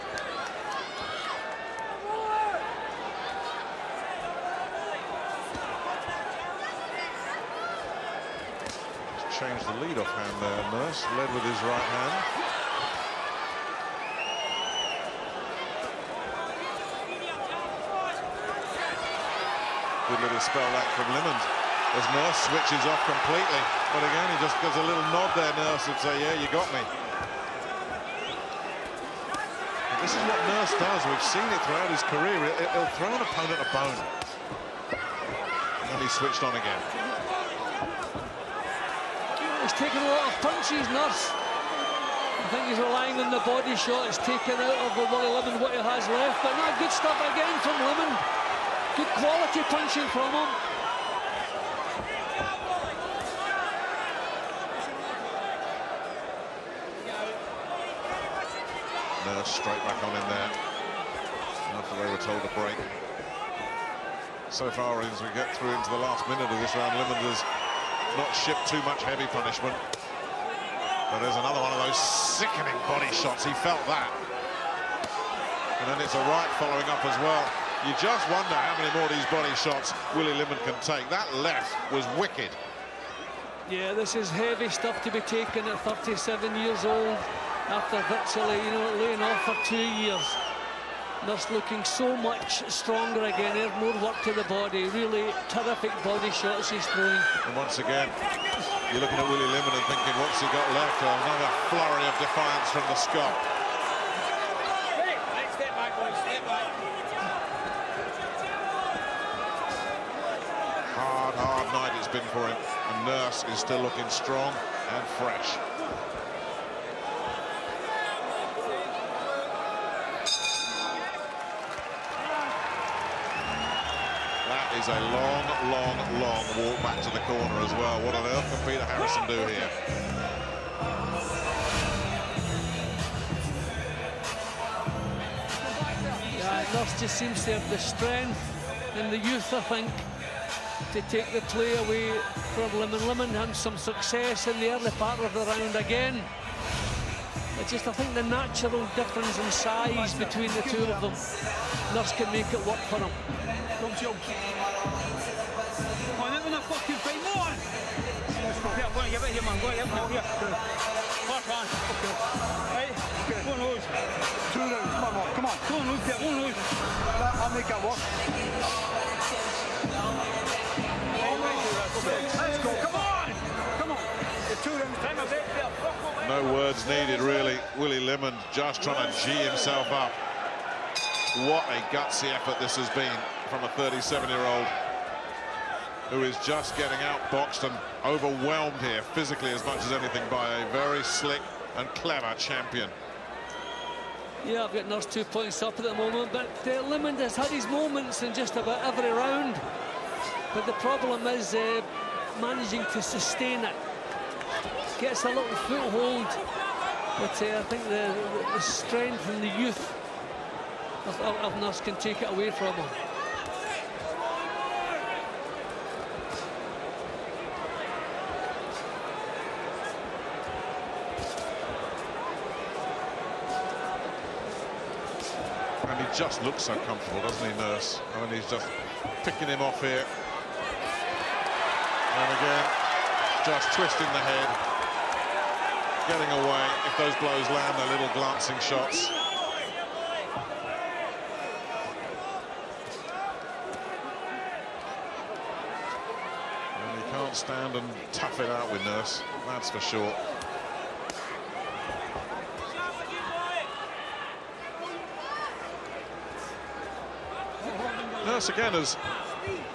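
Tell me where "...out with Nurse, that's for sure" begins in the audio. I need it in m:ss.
4:08.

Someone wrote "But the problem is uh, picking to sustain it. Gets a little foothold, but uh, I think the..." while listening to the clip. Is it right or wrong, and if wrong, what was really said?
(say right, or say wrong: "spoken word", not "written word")
wrong: "managing", not "picking".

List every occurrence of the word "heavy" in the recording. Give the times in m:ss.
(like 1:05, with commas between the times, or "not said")
1:09, 1:24.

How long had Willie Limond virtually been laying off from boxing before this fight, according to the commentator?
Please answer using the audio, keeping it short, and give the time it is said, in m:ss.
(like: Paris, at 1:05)
2 years, at 1:29.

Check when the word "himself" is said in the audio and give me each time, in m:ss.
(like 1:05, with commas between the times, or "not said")
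2:59.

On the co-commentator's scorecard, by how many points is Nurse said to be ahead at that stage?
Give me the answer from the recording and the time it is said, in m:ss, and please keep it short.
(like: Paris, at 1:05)
2 points, at 3:15.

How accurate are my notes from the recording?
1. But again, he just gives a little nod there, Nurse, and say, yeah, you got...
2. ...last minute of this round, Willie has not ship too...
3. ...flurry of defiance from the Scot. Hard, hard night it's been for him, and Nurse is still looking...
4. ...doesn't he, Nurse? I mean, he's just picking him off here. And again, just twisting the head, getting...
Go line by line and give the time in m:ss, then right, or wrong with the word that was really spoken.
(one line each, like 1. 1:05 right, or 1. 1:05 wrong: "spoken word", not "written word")
1. 0:23 right
2. 1:06 wrong: "Limond", not "Willie"
3. 1:41 right
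4. 3:47 right.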